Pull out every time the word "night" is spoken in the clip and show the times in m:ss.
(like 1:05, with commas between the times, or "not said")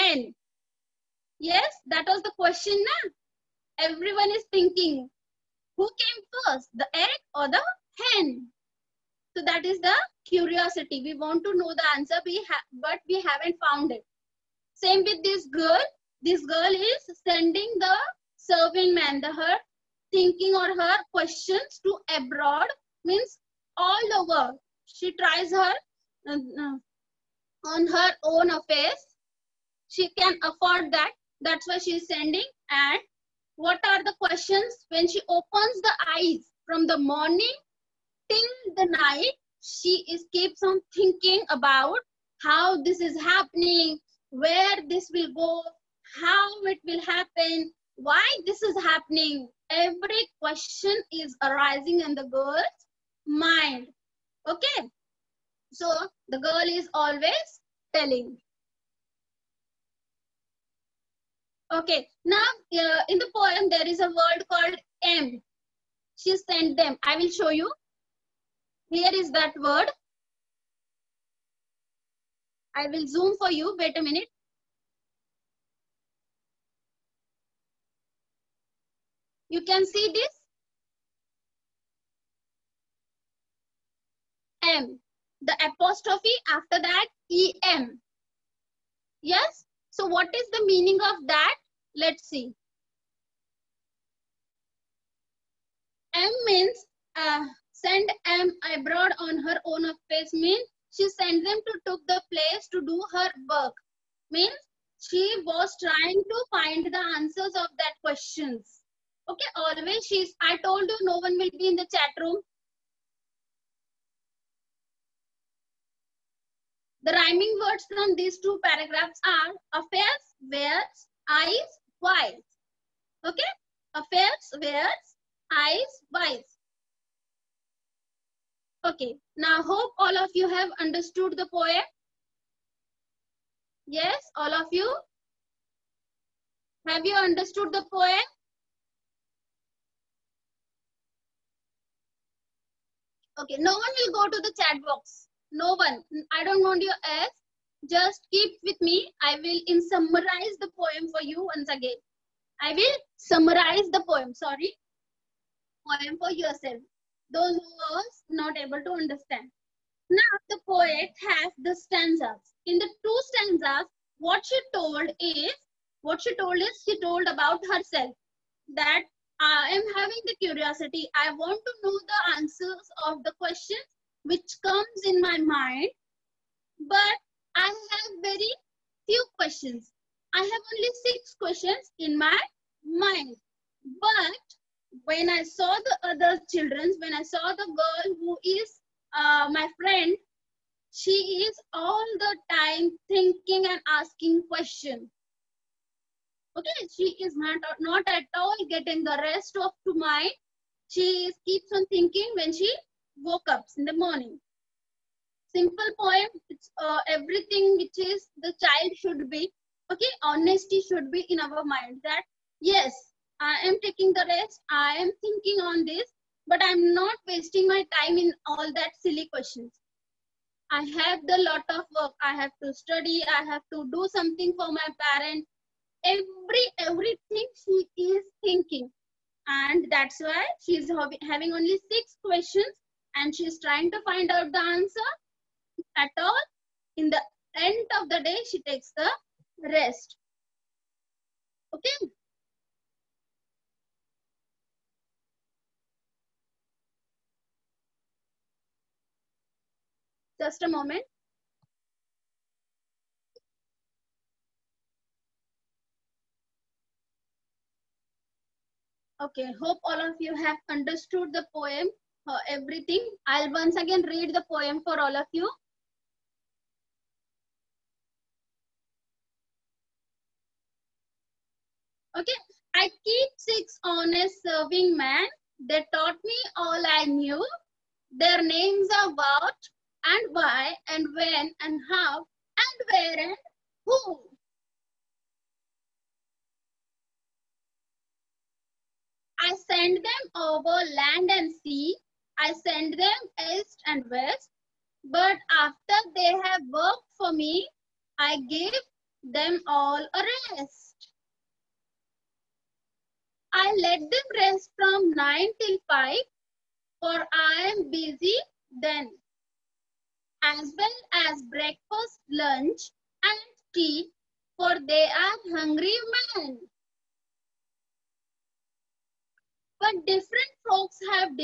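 0:38.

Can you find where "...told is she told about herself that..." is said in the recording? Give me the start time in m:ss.
2:46.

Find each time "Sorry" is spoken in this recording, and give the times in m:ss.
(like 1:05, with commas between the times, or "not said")
2:34.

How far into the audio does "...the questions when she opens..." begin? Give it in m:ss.
0:34.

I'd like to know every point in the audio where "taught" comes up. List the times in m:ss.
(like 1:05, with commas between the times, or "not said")
4:35.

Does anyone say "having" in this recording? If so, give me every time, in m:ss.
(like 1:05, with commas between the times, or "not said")
2:49, 3:51.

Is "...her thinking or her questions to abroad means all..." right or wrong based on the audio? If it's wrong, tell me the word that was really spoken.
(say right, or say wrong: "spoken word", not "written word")
right.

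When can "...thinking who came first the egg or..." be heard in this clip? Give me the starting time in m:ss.
0:04.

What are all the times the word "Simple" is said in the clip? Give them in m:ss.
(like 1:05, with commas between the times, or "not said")
3:25.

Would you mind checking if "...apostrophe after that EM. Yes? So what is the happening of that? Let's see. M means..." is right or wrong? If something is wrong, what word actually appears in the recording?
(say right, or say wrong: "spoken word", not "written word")
wrong: "meaning", not "happening".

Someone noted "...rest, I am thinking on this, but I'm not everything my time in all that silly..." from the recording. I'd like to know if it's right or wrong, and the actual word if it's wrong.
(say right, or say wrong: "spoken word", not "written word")
wrong: "wasting", not "everything".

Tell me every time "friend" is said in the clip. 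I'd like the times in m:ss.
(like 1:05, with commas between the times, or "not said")
3:09.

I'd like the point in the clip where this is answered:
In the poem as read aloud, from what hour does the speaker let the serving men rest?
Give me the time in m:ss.
5:05.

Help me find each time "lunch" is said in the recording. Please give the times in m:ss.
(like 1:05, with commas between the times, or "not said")
5:12.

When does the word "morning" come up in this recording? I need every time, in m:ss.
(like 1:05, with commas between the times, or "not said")
0:36, 3:23.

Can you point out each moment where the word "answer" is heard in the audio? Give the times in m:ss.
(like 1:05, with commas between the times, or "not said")
0:11, 1:47, 2:52, 3:54.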